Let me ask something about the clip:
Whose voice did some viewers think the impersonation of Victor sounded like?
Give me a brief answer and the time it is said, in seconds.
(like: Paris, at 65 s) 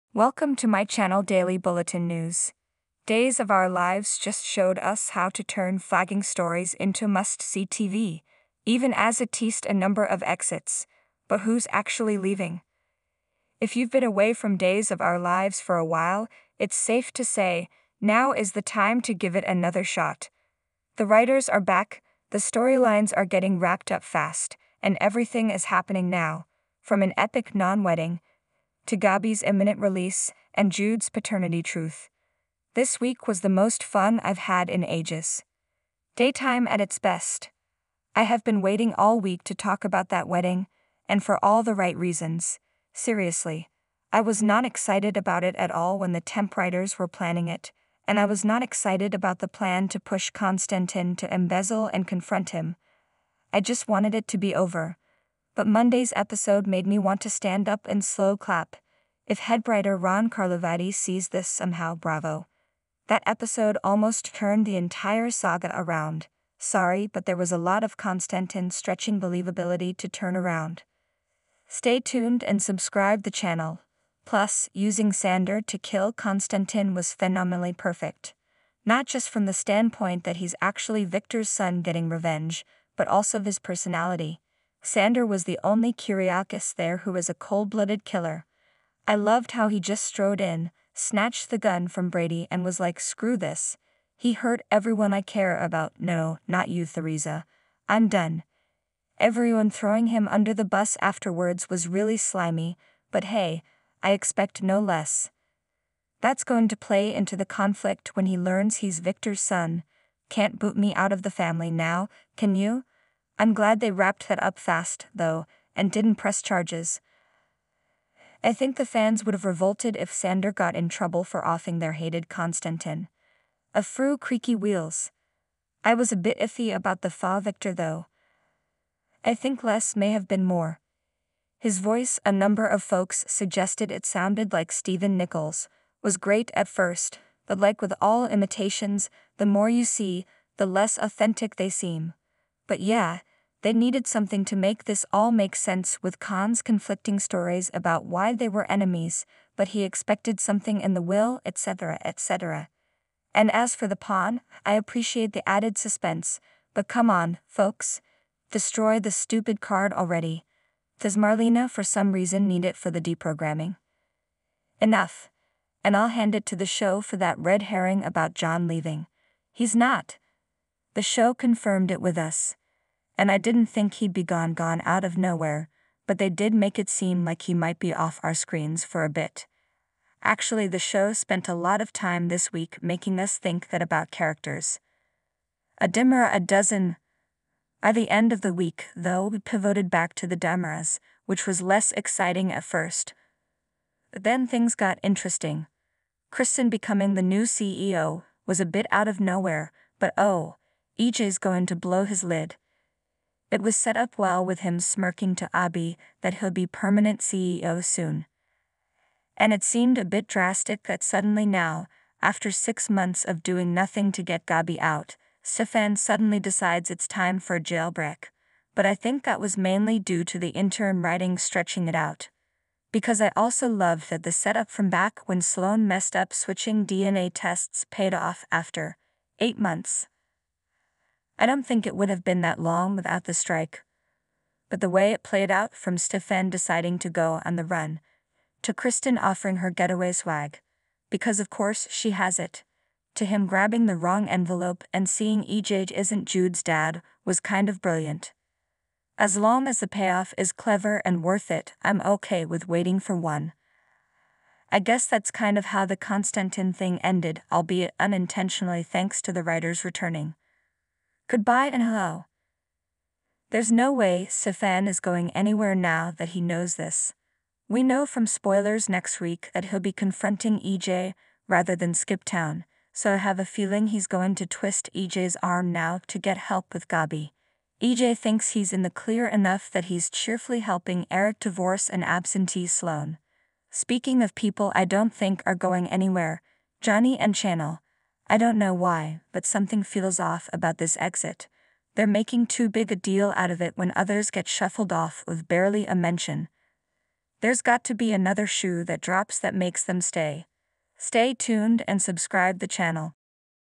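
Stephen Nichols, at 134 s.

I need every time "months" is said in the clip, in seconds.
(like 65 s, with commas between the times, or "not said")
212 s, 229 s.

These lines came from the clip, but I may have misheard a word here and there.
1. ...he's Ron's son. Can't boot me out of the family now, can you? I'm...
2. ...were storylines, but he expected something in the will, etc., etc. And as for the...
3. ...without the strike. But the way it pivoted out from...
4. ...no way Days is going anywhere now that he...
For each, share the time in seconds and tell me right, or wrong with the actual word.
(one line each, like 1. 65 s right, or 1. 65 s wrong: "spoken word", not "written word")
1. 108 s wrong: "Victor", not "Ron"
2. 148 s wrong: "enemies", not "storylines"
3. 232 s wrong: "played", not "pivoted"
4. 263 s wrong: "Stefan", not "Days".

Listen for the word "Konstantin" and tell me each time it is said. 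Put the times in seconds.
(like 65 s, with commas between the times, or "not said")
50 s, 67 s, 76 s, 122 s, 255 s.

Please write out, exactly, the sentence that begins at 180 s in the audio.
Actually, the show spent a lot of time this week making us think that about characters.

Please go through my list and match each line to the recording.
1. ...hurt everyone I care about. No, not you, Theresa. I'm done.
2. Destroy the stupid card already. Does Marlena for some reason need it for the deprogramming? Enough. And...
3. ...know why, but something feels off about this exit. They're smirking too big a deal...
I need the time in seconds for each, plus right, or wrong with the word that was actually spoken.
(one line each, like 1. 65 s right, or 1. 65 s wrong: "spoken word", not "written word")
1. 94 s right
2. 158 s right
3. 288 s wrong: "making", not "smirking".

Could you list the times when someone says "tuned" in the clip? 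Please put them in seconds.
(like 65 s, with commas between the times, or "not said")
72 s, 301 s.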